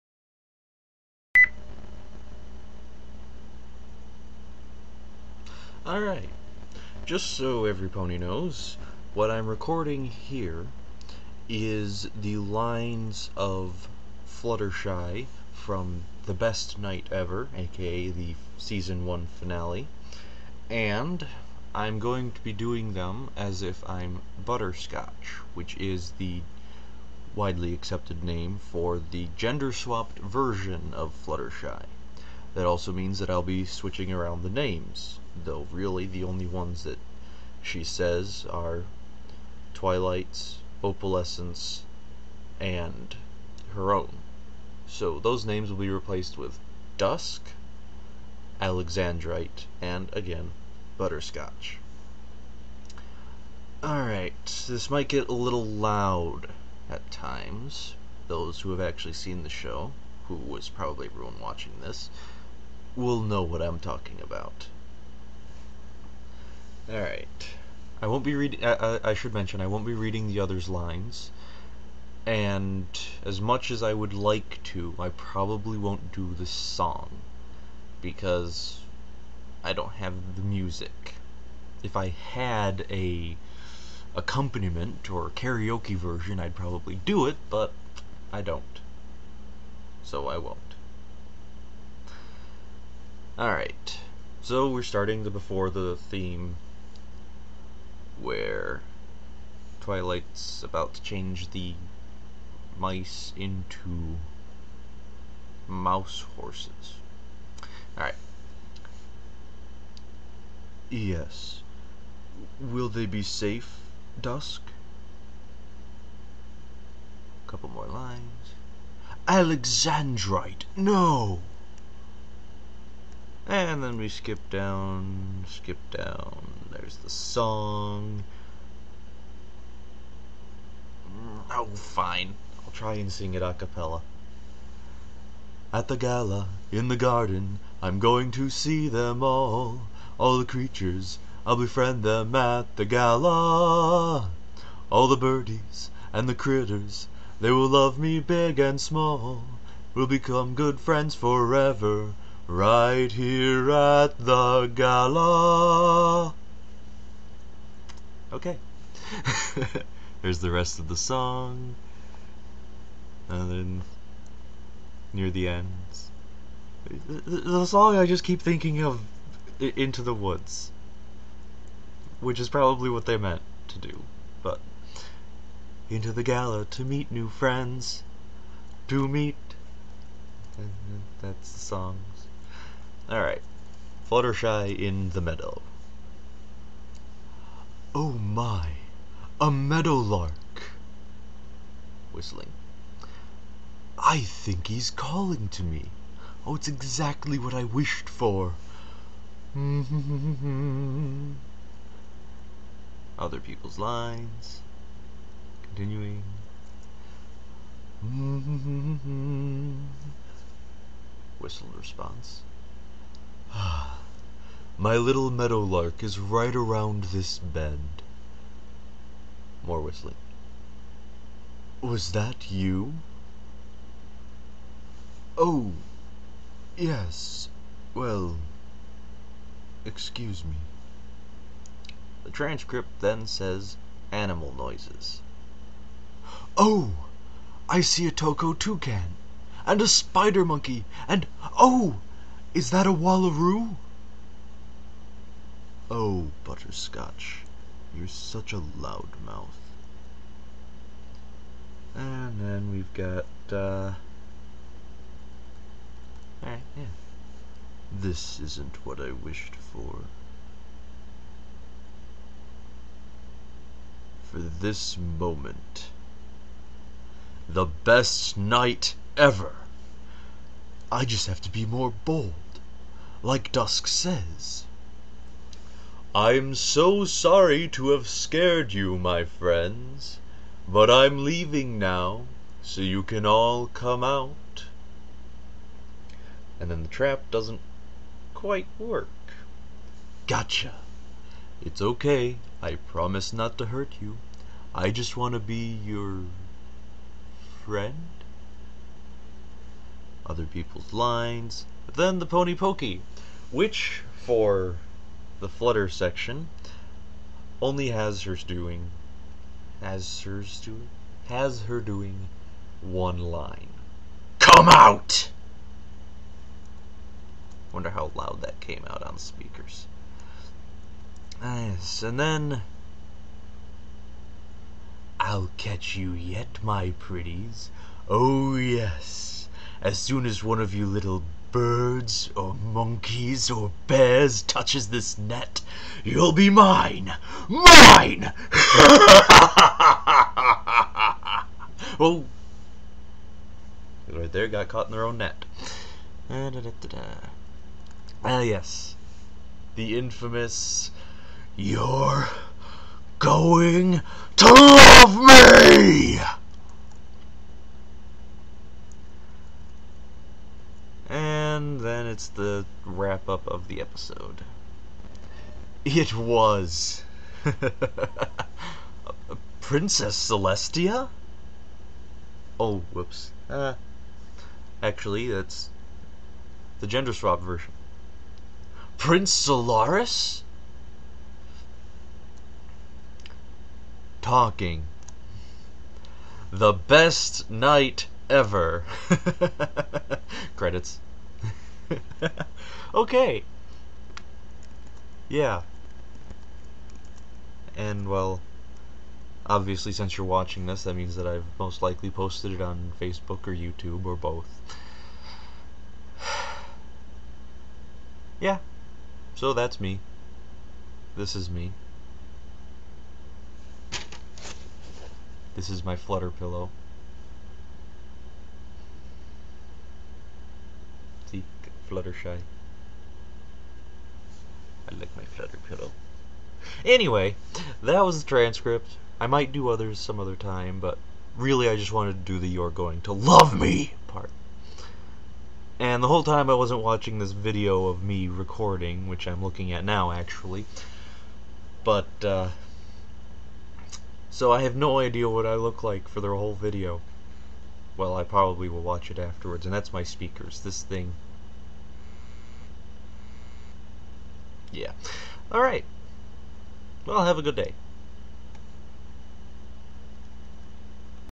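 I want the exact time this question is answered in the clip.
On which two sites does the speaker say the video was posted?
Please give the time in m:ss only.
6:42.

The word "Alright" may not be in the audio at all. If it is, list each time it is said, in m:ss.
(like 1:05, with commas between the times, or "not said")
0:05, 0:53, 1:06, 1:33, 1:47, 3:03, 4:16.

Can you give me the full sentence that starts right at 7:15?
And the whole time I wasn't watching this video of me recording, which I'm looking at now actually.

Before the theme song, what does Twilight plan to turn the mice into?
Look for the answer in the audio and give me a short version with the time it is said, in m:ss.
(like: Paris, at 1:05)
mouse horses, at 1:45.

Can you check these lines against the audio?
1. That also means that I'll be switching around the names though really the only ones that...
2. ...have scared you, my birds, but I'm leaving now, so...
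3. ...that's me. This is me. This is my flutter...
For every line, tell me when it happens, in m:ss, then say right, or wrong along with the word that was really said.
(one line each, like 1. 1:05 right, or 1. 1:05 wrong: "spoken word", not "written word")
1. 0:32 right
2. 4:37 wrong: "friends", not "birds"
3. 6:49 right.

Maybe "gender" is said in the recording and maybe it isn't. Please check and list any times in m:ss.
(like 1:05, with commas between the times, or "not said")
0:29, 6:16.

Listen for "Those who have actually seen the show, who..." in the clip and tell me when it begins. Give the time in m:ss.
0:58.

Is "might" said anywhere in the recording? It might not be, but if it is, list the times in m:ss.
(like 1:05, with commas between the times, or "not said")
0:54, 7:09.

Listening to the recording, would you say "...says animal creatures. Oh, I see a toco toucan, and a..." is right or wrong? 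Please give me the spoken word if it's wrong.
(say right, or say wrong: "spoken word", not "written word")
wrong: "noises", not "creatures".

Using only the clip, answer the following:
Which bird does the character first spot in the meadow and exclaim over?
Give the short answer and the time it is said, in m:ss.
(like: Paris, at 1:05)
meadowlark, at 3:09.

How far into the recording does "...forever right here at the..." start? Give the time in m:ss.
2:31.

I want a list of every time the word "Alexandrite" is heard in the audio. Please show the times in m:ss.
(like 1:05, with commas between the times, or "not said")
0:48, 1:59.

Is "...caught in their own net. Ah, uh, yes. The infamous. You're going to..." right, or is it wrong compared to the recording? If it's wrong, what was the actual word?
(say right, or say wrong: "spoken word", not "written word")
right.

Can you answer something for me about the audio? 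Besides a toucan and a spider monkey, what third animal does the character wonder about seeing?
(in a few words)
Wallaroo.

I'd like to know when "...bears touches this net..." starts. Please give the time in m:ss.
5:33.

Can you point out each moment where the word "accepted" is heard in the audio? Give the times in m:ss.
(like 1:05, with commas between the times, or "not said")
0:27.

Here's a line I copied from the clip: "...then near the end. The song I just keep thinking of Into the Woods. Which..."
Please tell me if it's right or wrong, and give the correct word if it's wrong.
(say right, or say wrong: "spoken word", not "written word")
right.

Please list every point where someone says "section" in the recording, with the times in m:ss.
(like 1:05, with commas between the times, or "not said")
5:05.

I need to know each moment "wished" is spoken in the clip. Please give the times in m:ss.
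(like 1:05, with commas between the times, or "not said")
3:17, 4:19.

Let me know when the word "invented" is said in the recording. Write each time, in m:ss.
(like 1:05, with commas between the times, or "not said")
not said.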